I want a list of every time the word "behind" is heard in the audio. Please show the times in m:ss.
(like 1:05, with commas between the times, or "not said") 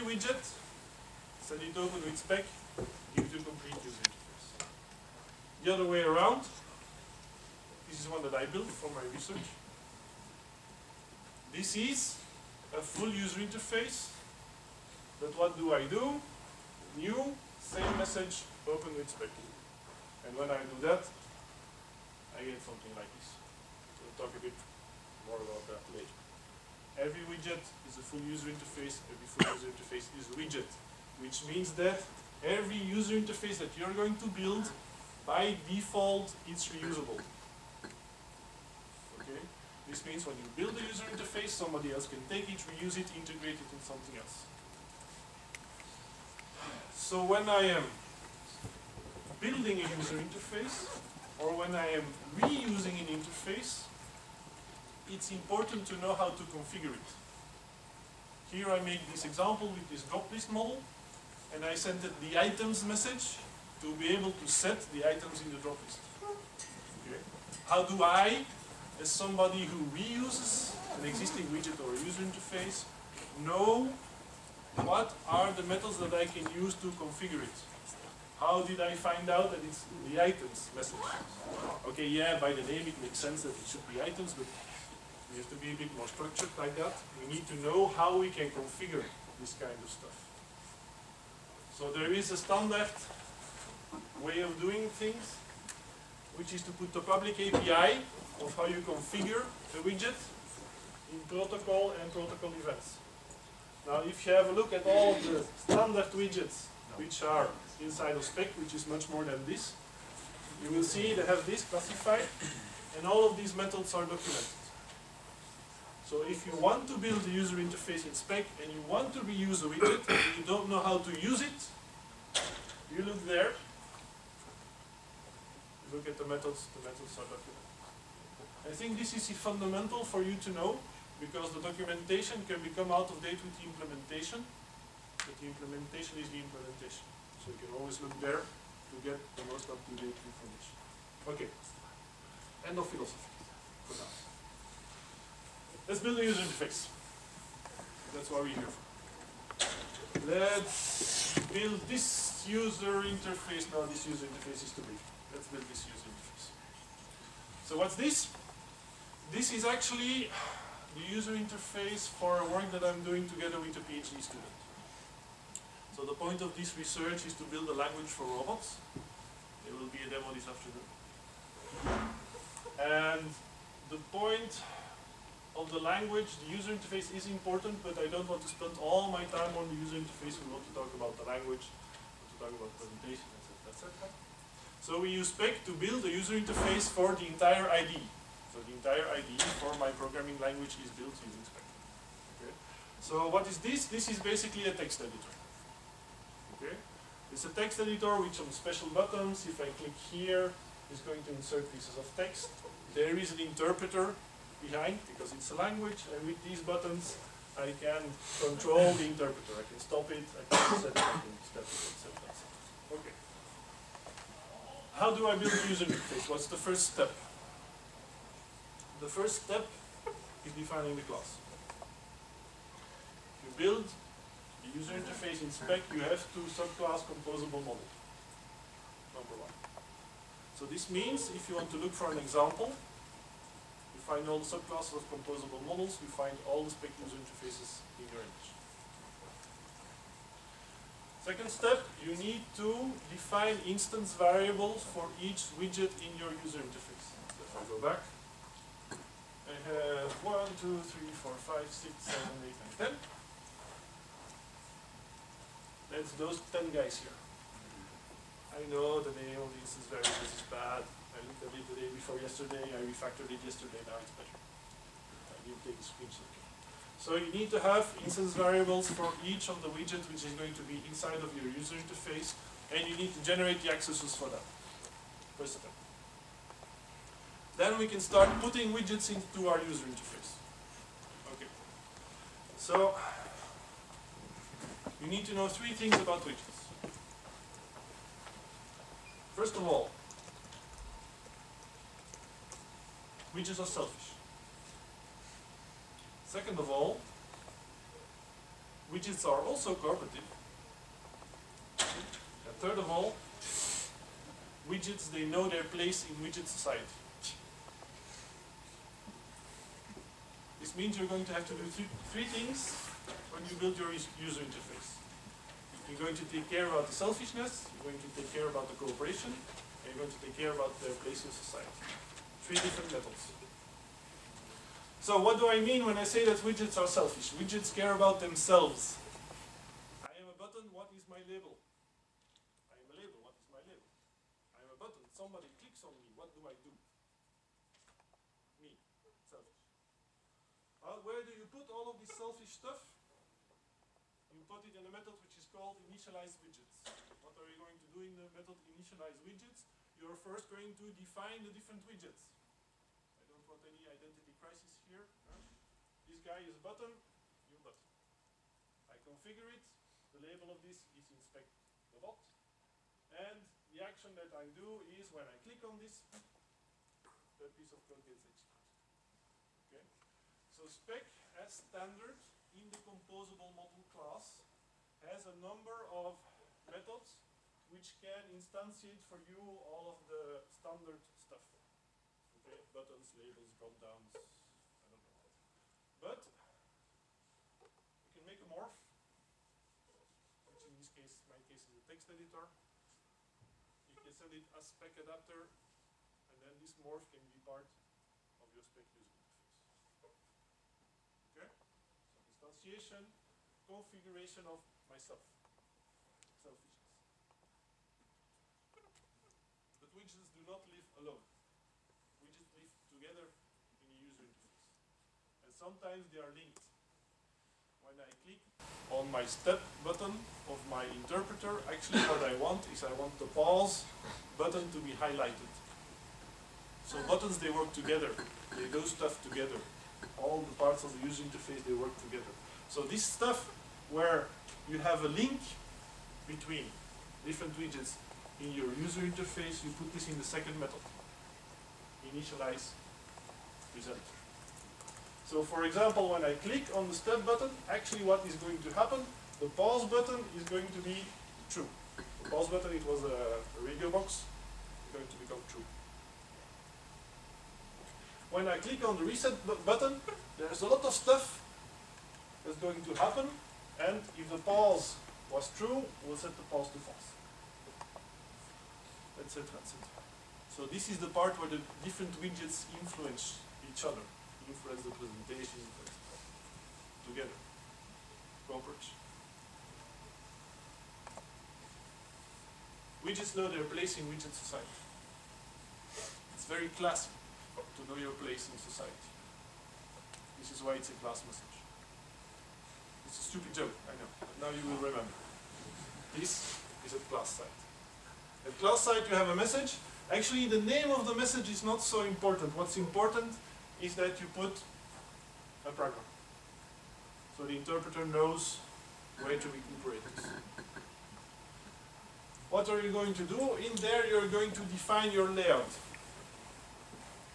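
3:24.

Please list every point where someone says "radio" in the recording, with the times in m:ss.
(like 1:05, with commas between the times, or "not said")
7:33.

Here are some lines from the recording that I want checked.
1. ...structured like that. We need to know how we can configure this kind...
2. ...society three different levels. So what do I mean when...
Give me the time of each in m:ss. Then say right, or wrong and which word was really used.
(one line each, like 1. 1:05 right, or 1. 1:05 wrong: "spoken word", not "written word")
1. 1:26 right
2. 5:21 right.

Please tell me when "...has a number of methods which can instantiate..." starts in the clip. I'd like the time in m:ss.
6:15.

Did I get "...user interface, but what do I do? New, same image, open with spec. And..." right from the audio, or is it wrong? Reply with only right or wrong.
wrong.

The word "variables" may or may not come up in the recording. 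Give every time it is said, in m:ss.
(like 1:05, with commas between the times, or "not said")
4:04, 4:19, 4:28.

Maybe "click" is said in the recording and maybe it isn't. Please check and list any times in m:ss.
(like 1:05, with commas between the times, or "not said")
3:19, 5:35, 6:05, 6:58, 7:26, 7:38.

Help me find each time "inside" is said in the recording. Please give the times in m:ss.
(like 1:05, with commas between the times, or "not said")
1:47, 4:30.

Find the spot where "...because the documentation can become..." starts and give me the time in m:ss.
2:11.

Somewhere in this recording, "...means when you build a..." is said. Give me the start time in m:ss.
0:40.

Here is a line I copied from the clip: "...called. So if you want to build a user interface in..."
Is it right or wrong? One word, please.
wrong.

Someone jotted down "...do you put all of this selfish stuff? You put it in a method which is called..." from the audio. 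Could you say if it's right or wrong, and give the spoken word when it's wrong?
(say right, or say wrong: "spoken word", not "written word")
right.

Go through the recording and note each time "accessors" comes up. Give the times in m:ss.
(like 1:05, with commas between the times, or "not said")
4:33.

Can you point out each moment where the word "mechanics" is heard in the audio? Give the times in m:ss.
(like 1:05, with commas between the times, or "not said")
not said.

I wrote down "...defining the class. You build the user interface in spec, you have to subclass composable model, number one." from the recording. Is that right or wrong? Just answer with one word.
right.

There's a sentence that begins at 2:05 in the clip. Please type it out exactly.
look at the methods, the methods are documented.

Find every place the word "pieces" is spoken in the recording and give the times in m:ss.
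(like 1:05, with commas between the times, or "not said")
3:21, 6:07.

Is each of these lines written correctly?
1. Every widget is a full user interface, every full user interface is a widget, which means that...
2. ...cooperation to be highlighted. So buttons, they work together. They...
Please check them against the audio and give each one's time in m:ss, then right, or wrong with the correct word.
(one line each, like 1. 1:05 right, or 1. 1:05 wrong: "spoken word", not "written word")
1. 0:27 right
2. 7:04 wrong: "button", not "cooperation".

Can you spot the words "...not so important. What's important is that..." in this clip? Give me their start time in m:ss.
8:21.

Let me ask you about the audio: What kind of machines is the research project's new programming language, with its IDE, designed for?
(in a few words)
robots.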